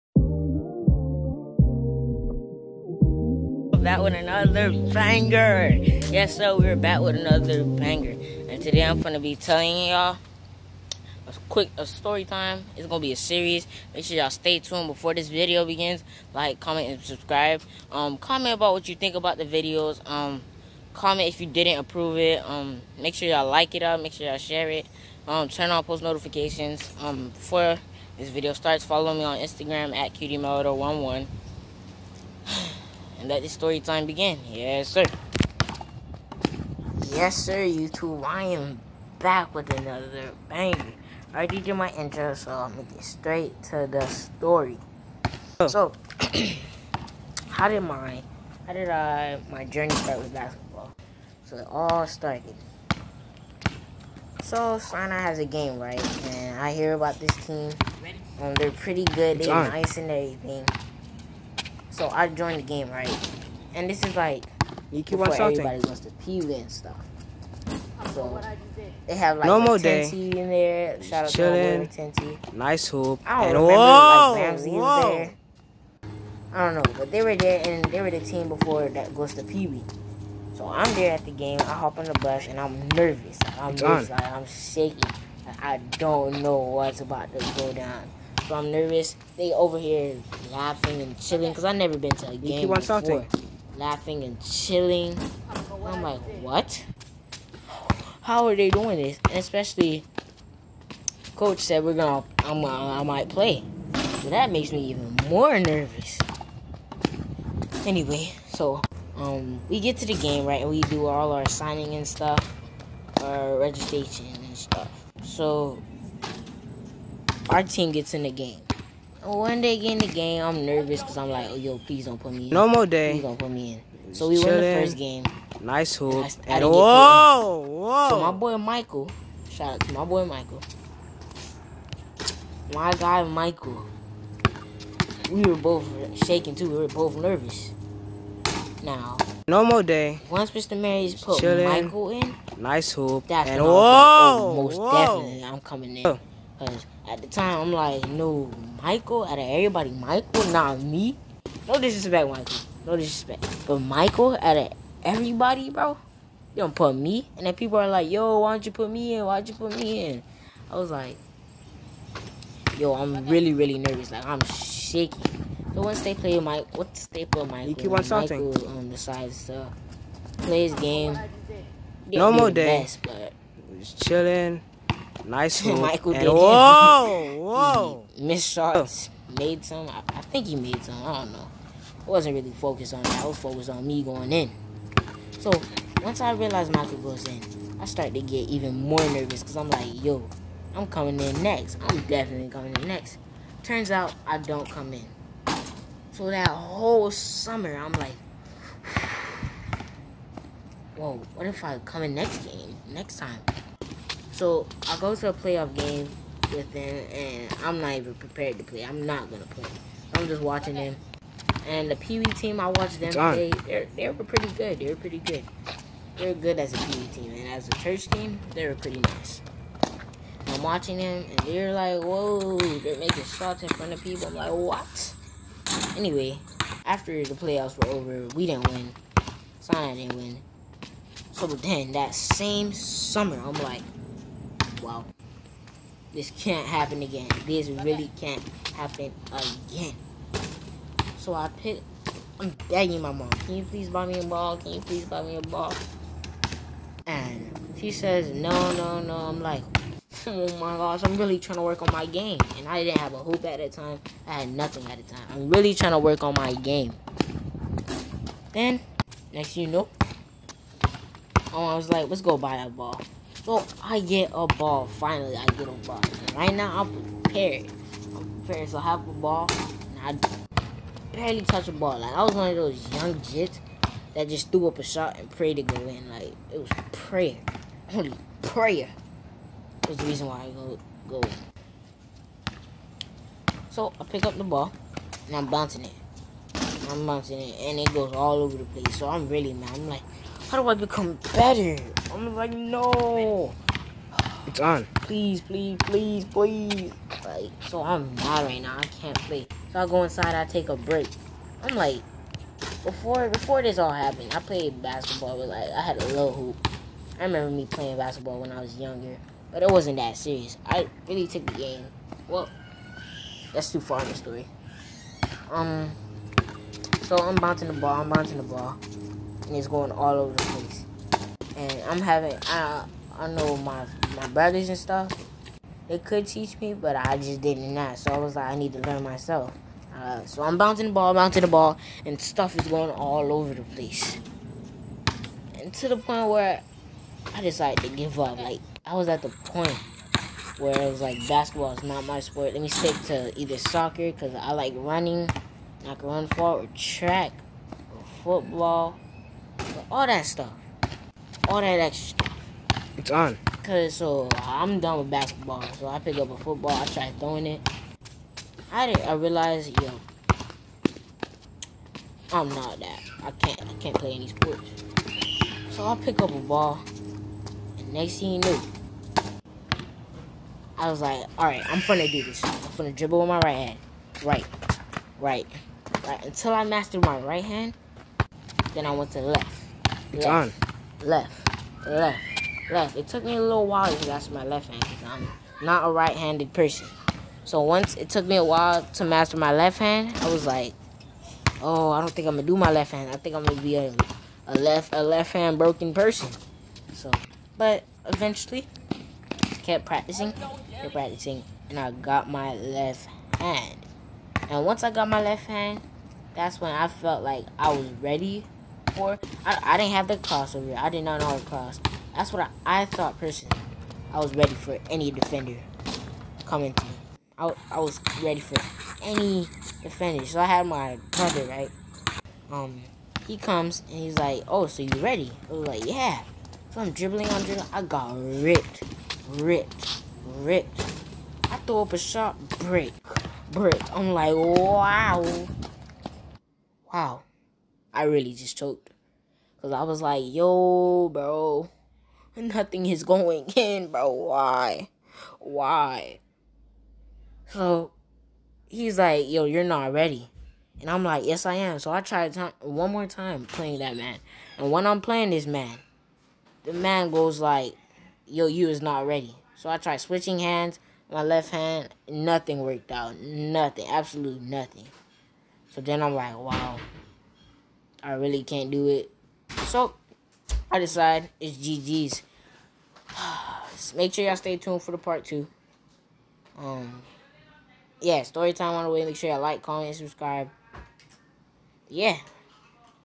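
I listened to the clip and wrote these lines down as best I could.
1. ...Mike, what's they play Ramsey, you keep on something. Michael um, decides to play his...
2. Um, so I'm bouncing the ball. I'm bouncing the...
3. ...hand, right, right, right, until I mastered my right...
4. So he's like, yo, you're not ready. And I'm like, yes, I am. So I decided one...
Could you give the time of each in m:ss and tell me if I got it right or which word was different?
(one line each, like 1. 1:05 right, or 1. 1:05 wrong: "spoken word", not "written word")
1. 2:46 wrong: "Michael", not "Ramsey"
2. 5:15 right
3. 6:13 right
4. 7:27 wrong: "tried", not "decided".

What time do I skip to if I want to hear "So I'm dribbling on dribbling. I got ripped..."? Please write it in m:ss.
7:06.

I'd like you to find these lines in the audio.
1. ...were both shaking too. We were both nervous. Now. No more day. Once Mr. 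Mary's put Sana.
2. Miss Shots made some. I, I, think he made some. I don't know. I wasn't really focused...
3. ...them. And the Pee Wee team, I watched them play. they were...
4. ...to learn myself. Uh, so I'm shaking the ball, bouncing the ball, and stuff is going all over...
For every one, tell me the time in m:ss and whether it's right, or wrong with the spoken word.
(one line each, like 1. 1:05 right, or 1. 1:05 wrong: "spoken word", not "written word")
1. 2:15 wrong: "Chilling", not "Sana"
2. 2:58 right
3. 3:30 right
4. 5:28 wrong: "bouncing", not "shaking".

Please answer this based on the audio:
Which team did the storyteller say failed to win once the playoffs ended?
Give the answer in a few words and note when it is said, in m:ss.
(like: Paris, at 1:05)
Sinai, at 3:49.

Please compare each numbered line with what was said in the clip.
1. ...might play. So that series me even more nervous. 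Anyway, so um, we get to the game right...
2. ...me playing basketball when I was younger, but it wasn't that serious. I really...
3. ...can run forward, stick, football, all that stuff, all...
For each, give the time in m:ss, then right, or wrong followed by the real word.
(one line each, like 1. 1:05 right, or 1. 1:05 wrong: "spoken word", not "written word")
1. 1:43 wrong: "makes", not "series"
2. 5:07 right
3. 5:45 wrong: "track", not "stick".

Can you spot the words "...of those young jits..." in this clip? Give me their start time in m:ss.
4:32.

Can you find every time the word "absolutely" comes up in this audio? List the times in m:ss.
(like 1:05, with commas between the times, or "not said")
7:43.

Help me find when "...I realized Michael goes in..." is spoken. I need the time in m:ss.
3:06.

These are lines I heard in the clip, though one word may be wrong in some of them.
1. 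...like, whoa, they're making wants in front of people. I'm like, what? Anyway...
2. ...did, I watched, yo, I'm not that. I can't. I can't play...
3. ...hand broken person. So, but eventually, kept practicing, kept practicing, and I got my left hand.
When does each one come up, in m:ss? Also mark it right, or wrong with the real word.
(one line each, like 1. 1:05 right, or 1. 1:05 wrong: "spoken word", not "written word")
1. 3:41 wrong: "shots", not "wants"
2. 5:58 wrong: "realized", not "watched"
3. 6:35 right.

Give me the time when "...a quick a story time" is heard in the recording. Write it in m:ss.
0:11.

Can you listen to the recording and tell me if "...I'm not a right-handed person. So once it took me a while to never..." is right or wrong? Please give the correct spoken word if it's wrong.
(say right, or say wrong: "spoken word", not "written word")
wrong: "master", not "never".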